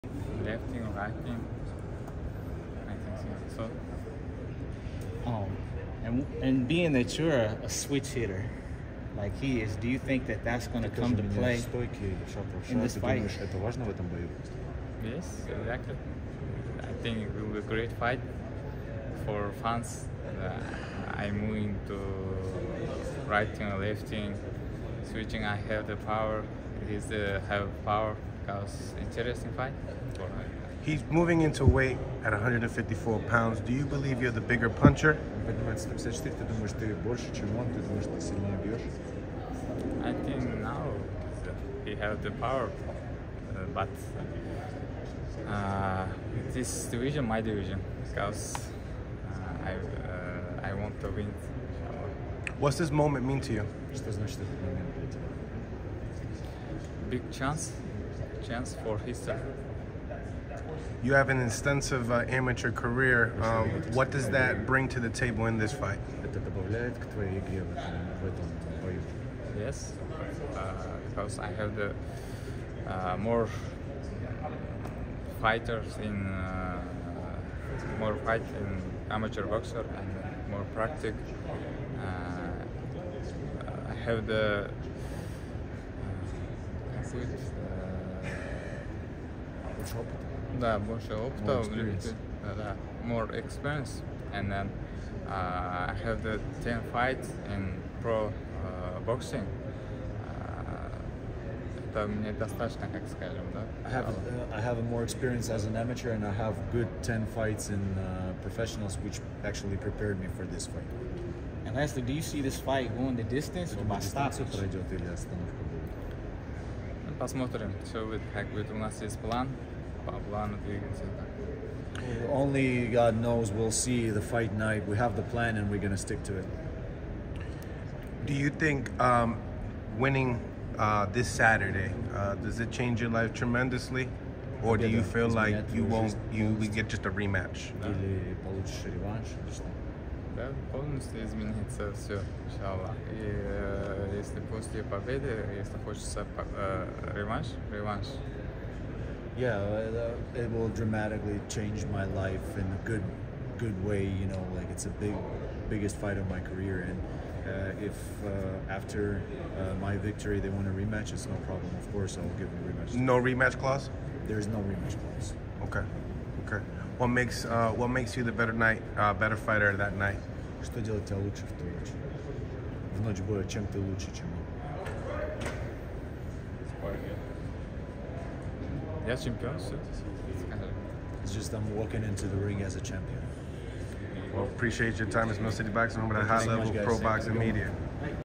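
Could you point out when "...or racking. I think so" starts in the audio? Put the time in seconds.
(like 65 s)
0 s.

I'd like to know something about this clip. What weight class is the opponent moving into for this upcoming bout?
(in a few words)
154.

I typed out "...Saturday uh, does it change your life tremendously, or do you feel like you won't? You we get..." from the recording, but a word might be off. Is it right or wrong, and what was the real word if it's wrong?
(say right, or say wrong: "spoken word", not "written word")
right.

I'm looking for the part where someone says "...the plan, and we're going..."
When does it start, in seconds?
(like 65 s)
125 s.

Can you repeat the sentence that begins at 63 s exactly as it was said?
Um, what does that bring to the table in this fight?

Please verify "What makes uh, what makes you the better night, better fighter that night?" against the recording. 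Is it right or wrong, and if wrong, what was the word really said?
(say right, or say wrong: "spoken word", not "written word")
right.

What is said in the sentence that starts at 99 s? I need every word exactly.
Uh, это мне достаточно, как скажем, да?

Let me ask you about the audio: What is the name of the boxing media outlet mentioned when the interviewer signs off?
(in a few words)
Mill City Boxing.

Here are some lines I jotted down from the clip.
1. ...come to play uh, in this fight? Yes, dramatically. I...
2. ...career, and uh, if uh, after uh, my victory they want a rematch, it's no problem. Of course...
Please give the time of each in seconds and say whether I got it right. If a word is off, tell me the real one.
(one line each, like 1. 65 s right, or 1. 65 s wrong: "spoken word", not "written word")
1. 10 s wrong: "exactly", not "dramatically"
2. 156 s right.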